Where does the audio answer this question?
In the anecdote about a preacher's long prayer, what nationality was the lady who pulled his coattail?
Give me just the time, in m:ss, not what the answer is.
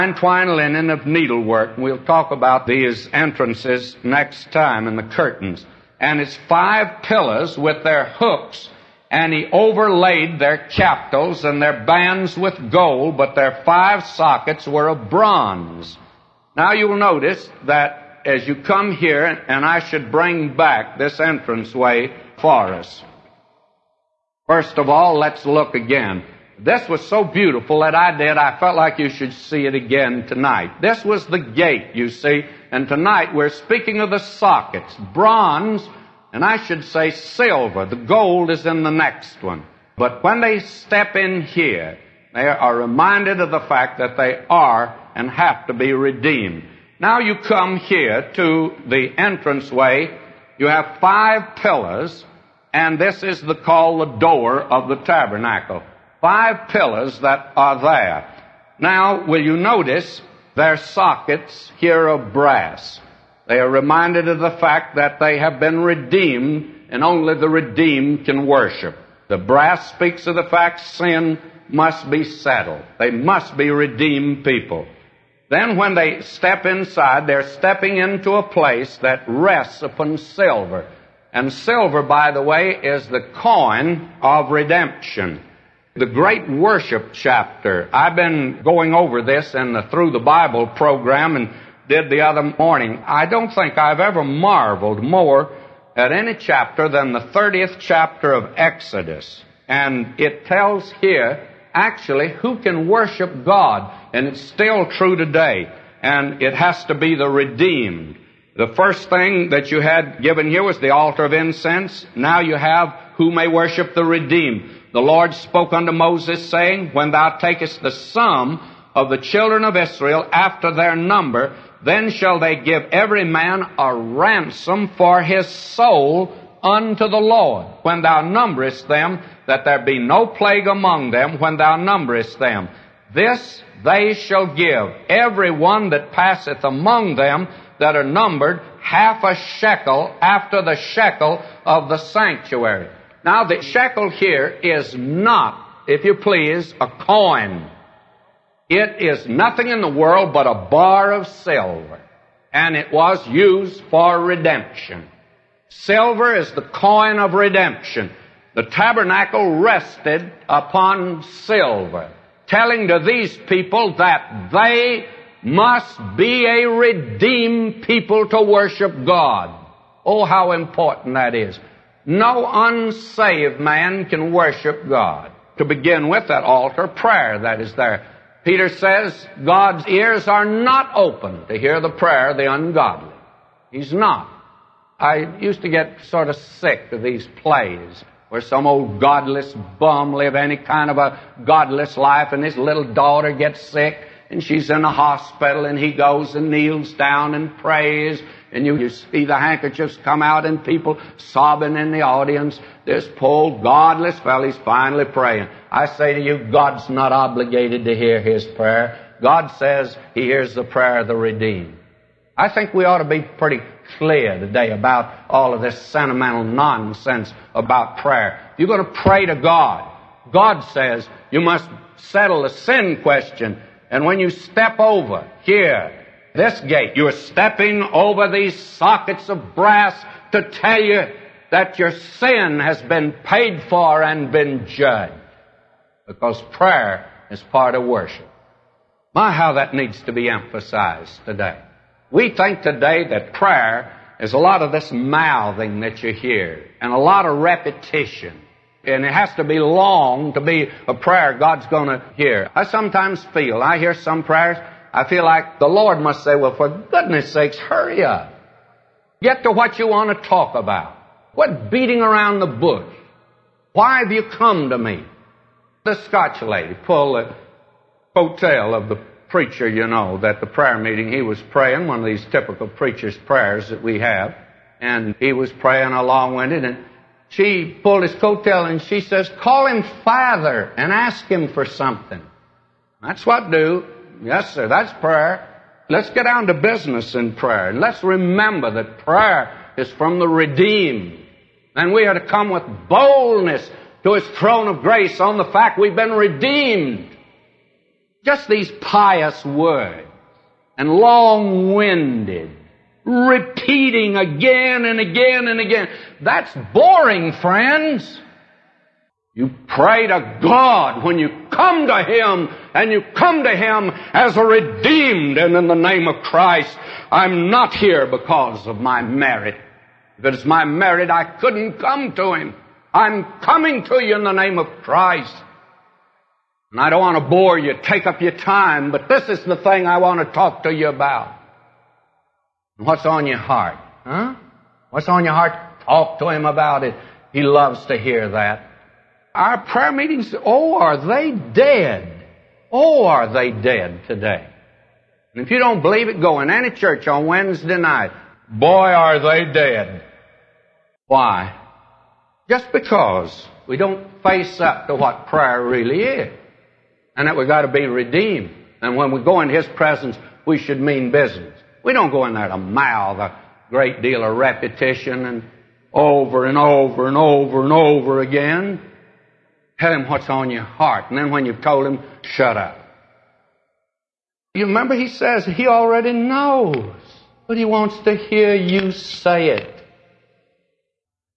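4:26.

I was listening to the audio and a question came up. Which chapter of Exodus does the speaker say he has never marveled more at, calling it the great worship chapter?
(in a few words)
30th.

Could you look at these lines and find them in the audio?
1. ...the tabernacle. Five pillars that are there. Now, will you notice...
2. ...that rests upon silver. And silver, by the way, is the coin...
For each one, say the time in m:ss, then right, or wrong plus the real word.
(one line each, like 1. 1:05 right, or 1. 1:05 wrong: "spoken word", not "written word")
1. 0:54 right
2. 1:18 right.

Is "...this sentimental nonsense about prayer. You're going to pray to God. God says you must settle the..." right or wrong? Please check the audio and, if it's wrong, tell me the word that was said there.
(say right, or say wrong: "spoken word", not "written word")
right.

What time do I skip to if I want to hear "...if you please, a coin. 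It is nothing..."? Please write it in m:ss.
2:25.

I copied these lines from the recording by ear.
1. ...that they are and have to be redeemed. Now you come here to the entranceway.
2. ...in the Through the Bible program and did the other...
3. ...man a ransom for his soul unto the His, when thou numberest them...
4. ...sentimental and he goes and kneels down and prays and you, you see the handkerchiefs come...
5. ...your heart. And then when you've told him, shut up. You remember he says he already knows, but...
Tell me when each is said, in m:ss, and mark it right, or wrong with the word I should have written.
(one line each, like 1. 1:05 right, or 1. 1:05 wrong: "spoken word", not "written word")
1. 0:43 right
2. 1:29 right
3. 2:03 wrong: "Lord", not "His"
4. 3:14 wrong: "hospital", not "sentimental"
5. 6:10 right.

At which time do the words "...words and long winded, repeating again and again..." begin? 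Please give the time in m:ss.
4:59.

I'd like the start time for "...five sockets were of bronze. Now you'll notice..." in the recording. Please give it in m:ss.
0:13.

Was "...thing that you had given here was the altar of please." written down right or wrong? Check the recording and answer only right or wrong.
wrong.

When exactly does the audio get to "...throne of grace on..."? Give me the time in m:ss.
4:54.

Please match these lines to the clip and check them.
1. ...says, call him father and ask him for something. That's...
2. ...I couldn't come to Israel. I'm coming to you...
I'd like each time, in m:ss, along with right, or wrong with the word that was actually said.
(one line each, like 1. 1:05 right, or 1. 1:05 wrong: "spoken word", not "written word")
1. 4:39 right
2. 5:21 wrong: "Him", not "Israel".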